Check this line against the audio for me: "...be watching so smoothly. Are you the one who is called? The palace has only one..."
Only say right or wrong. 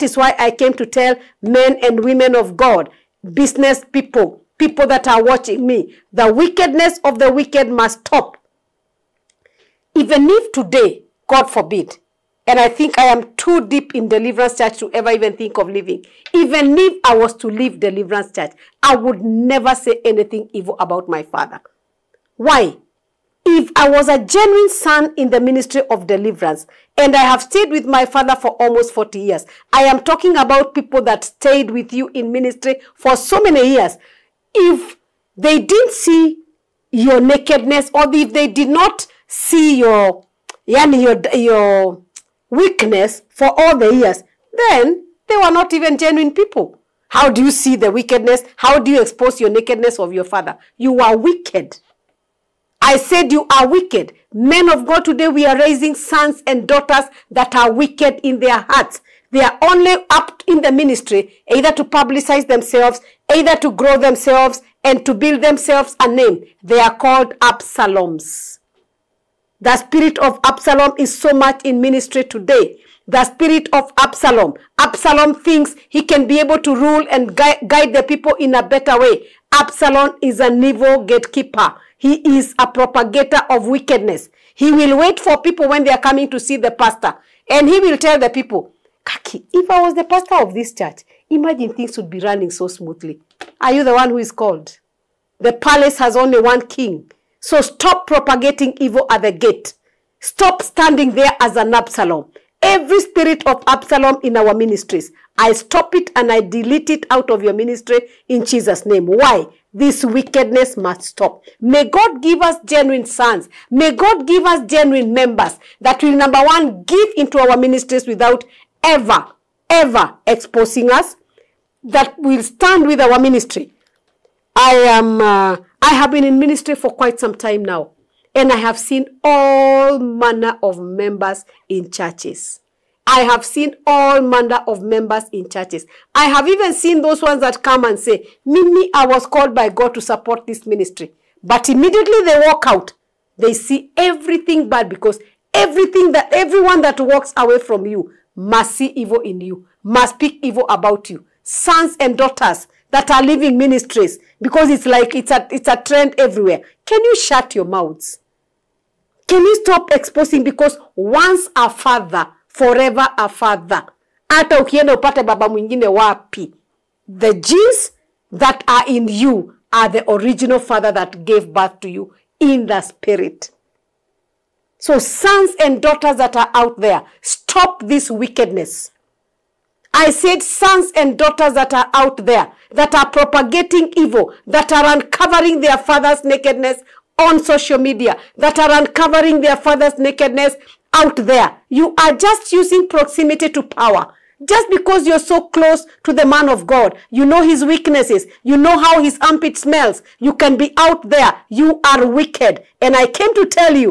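wrong.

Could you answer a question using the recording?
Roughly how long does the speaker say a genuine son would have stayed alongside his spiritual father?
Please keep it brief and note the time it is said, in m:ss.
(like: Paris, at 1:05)
almost 40 years, at 0:28.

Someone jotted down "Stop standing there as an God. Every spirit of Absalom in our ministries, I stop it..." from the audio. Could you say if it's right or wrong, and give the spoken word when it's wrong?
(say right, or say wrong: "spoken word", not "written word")
wrong: "Absalom", not "God".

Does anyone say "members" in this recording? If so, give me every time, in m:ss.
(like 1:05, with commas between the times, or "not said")
1:55, 2:10, 2:14.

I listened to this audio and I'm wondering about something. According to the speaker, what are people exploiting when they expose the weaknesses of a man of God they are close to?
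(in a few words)
proximity to power.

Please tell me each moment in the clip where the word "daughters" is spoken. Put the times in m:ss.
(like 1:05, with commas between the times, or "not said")
0:56, 2:32, 2:55, 3:01.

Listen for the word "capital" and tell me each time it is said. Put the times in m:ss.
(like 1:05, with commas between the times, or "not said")
not said.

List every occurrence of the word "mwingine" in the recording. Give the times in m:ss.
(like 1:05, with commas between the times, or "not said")
2:45.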